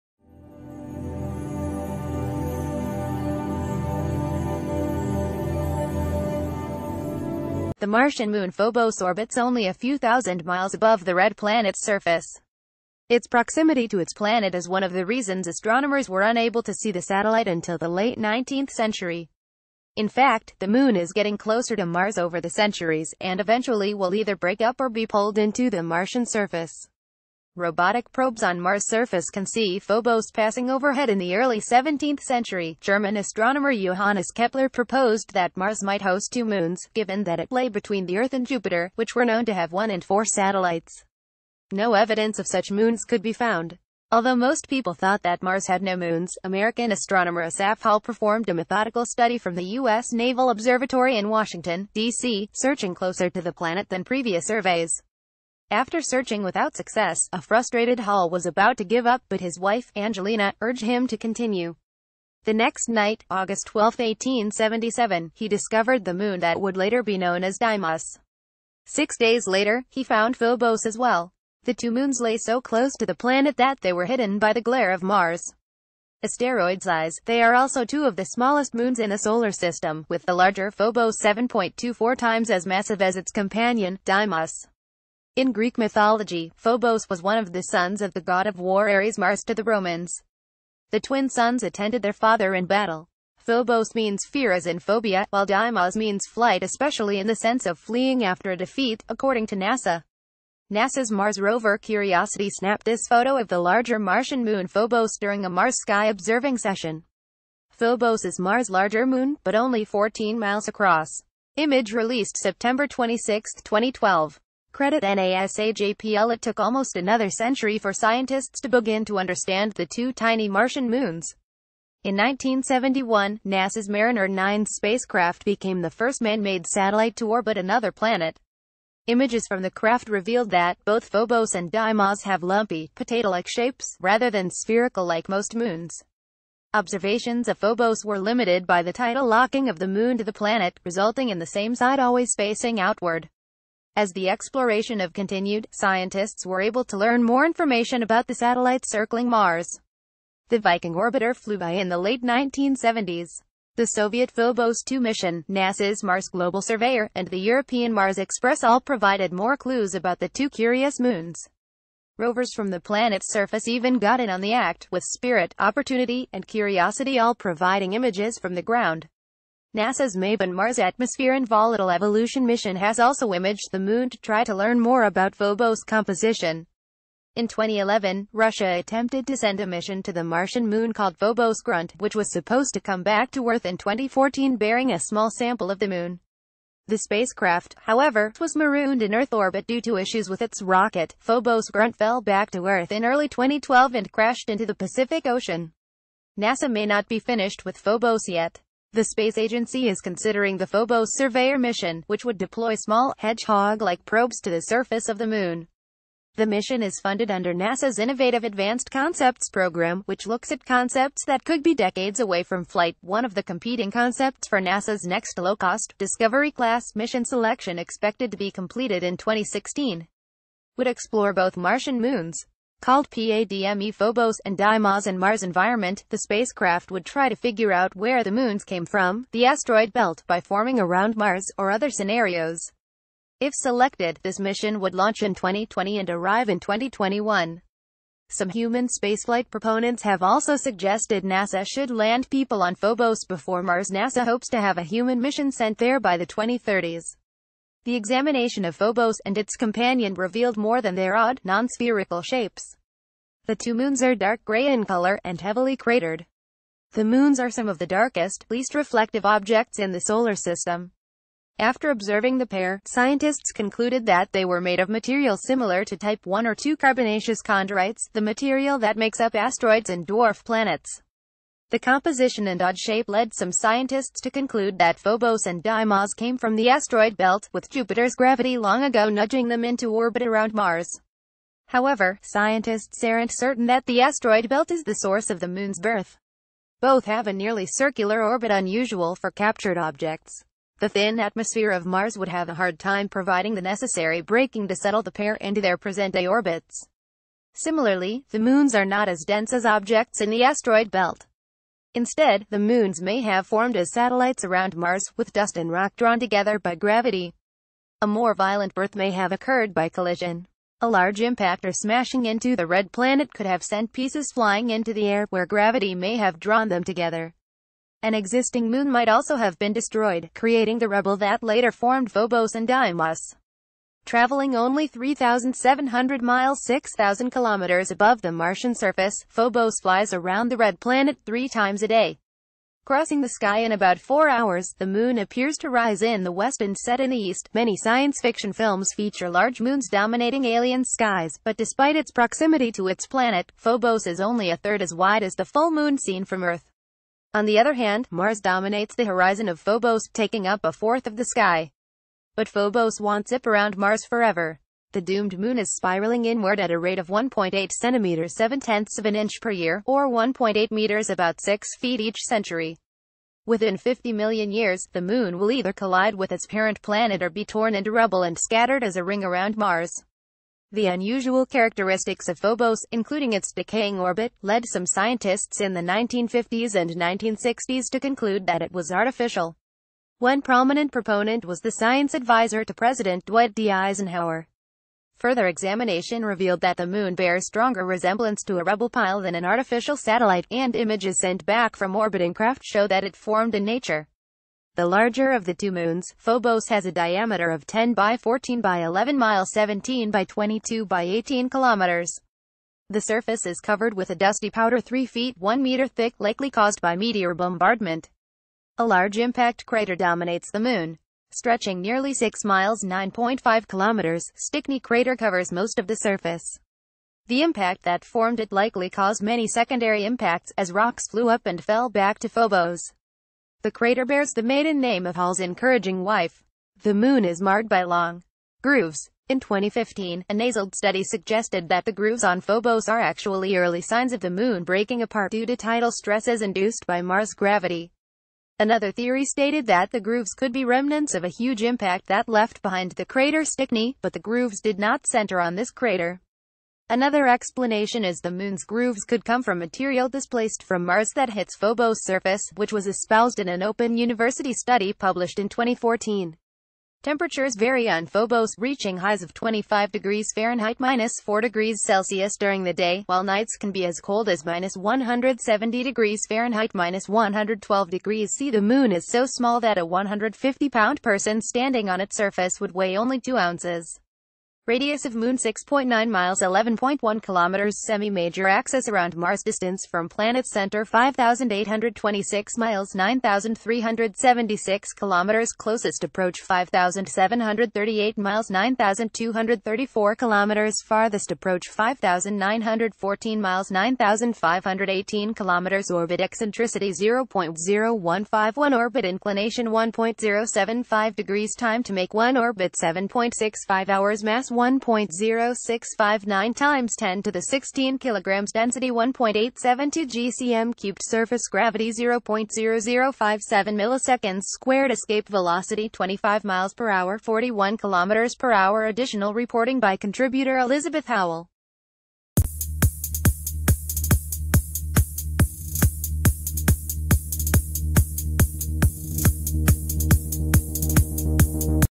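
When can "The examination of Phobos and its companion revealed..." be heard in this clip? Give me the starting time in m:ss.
4:07.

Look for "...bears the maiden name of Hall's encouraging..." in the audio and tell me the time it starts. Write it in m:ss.
7:04.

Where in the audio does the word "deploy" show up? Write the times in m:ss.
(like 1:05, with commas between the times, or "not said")
3:22.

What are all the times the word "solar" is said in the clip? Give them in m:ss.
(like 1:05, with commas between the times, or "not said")
1:19, 4:20.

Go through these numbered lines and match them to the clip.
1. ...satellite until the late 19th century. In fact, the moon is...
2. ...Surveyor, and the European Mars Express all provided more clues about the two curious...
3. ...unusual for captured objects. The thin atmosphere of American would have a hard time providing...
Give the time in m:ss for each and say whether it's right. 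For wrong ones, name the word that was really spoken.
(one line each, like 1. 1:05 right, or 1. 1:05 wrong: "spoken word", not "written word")
1. 0:17 right
2. 2:36 right
3. 4:48 wrong: "Mars", not "American".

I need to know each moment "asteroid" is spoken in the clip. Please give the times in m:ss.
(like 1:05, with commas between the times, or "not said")
1:16, 3:49, 4:29, 4:36, 4:44, 5:00.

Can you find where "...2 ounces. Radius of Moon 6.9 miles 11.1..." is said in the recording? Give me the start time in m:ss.
7:53.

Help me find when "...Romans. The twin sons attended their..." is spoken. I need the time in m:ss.
1:29.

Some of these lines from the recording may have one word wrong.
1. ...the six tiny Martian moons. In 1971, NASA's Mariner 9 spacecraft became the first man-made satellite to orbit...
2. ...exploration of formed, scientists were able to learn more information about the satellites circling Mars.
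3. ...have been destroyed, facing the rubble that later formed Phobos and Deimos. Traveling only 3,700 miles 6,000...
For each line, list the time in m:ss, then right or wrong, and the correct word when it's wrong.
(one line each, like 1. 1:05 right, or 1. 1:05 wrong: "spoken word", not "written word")
1. 1:59 wrong: "two", not "six"
2. 2:24 wrong: "continued", not "formed"
3. 5:19 wrong: "creating", not "facing".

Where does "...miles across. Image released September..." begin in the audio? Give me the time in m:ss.
1:50.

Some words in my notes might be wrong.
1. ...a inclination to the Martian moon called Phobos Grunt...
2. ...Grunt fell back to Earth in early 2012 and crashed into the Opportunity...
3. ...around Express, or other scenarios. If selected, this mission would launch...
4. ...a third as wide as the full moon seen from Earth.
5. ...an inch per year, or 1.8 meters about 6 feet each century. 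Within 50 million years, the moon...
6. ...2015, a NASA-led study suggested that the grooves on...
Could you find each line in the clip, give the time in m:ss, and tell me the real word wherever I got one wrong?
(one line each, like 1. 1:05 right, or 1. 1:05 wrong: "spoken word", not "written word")
1. 2:59 wrong: "mission", not "inclination"
2. 3:11 wrong: "Pacific", not "Opportunity"
3. 3:50 wrong: "Mars", not "Express"
4. 5:44 right
5. 5:59 right
6. 7:09 right.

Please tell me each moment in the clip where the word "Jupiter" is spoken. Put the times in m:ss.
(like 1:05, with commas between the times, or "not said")
0:38, 4:37.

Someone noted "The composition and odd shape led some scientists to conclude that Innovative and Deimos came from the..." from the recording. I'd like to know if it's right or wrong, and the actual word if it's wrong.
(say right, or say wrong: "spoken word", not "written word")
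wrong: "Phobos", not "Innovative".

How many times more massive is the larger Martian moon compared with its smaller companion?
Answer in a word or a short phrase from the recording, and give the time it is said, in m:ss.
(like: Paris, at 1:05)
7.24, at 1:21.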